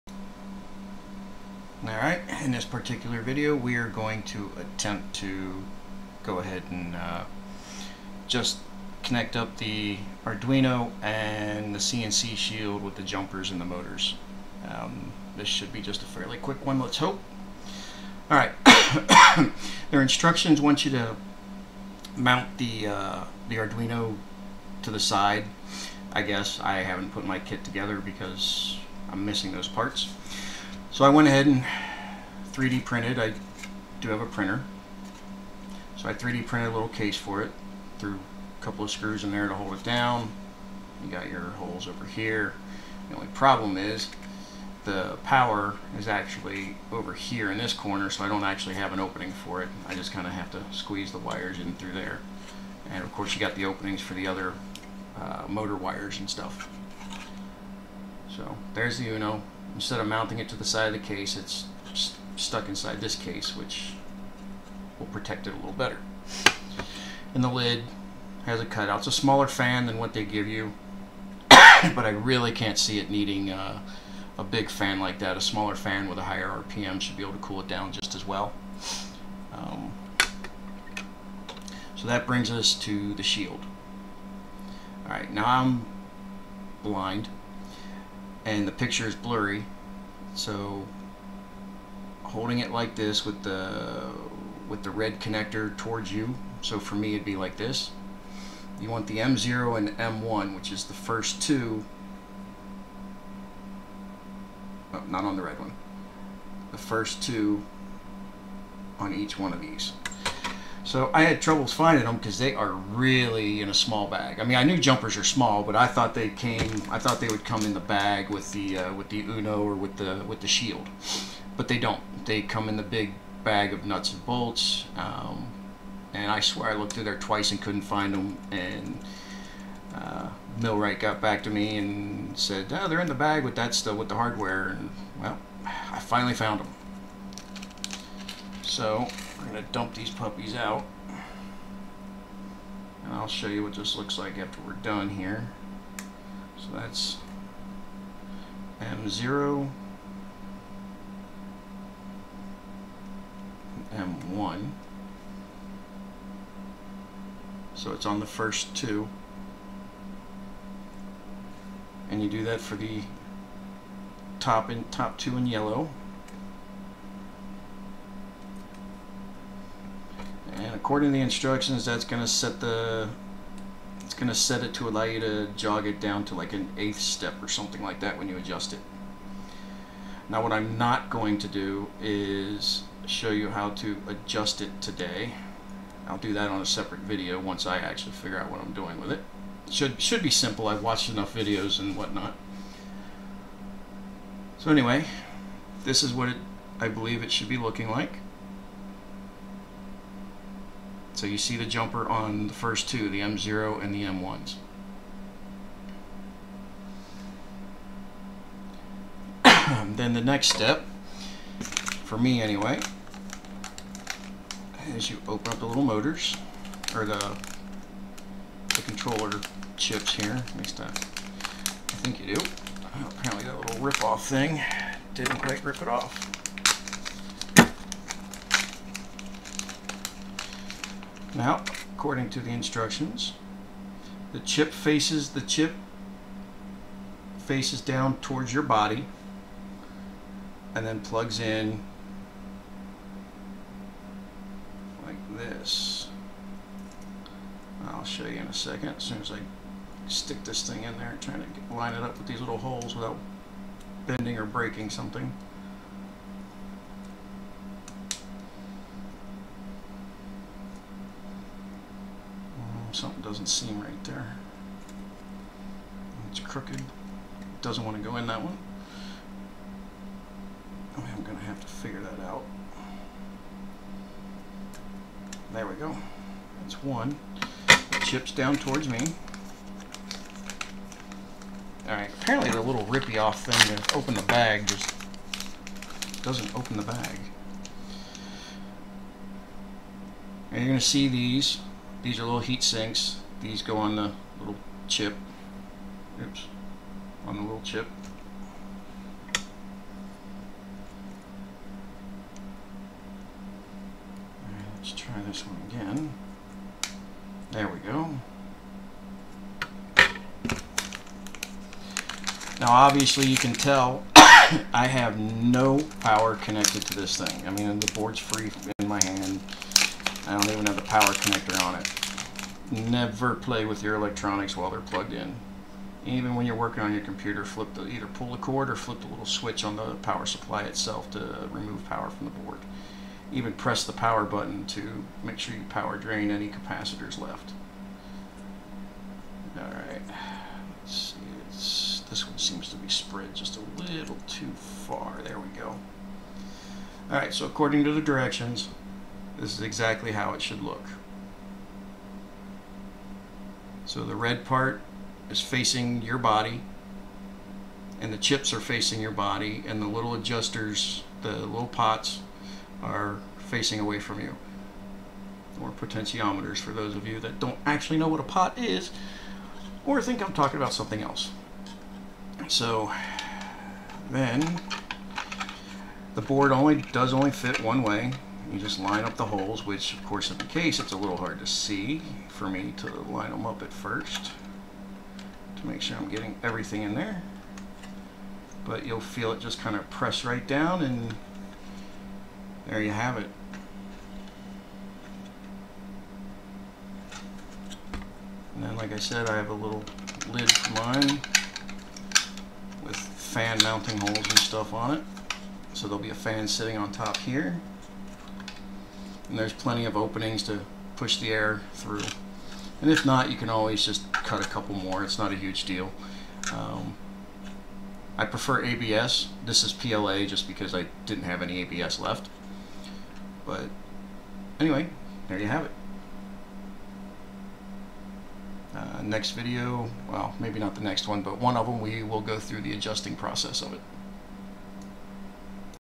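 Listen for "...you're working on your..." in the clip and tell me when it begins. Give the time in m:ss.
5:26.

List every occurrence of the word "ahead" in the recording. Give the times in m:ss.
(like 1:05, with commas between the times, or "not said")
0:06, 0:31.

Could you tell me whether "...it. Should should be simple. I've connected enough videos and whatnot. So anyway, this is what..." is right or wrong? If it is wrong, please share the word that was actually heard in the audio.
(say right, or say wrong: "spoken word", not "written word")
wrong: "watched", not "connected".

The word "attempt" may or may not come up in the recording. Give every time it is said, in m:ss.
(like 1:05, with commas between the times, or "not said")
0:04.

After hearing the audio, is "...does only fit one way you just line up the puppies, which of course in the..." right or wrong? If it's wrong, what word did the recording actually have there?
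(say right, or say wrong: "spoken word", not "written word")
wrong: "holes", not "puppies".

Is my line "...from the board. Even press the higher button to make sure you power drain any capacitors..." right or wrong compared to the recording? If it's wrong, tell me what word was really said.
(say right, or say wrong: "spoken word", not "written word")
wrong: "power", not "higher".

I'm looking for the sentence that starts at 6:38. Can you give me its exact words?
And then like I said, I have a little lid for mine with fan mounting holes and stuff on it.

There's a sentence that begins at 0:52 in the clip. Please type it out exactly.
And of course you got the openings for the other uh, motor wires and stuff.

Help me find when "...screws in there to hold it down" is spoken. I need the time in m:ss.
0:38.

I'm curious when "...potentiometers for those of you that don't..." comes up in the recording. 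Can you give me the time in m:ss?
6:05.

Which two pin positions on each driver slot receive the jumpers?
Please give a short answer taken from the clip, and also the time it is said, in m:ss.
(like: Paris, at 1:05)
M0 and M1, at 3:23.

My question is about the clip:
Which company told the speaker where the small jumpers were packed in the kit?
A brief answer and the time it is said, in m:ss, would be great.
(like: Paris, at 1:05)
MillRight, at 2:10.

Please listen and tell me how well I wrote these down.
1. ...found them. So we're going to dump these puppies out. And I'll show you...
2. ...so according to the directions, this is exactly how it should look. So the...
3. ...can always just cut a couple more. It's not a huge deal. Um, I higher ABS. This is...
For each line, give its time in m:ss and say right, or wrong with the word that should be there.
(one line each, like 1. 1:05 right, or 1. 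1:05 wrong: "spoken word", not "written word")
1. 2:16 right
2. 5:47 right
3. 6:53 wrong: "prefer", not "higher".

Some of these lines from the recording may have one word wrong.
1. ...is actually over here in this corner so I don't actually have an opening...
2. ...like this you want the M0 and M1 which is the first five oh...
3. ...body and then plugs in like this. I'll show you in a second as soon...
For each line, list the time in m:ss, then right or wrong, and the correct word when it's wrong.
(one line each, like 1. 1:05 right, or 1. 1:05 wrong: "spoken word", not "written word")
1. 0:45 right
2. 1:37 wrong: "two", not "five"
3. 3:58 right.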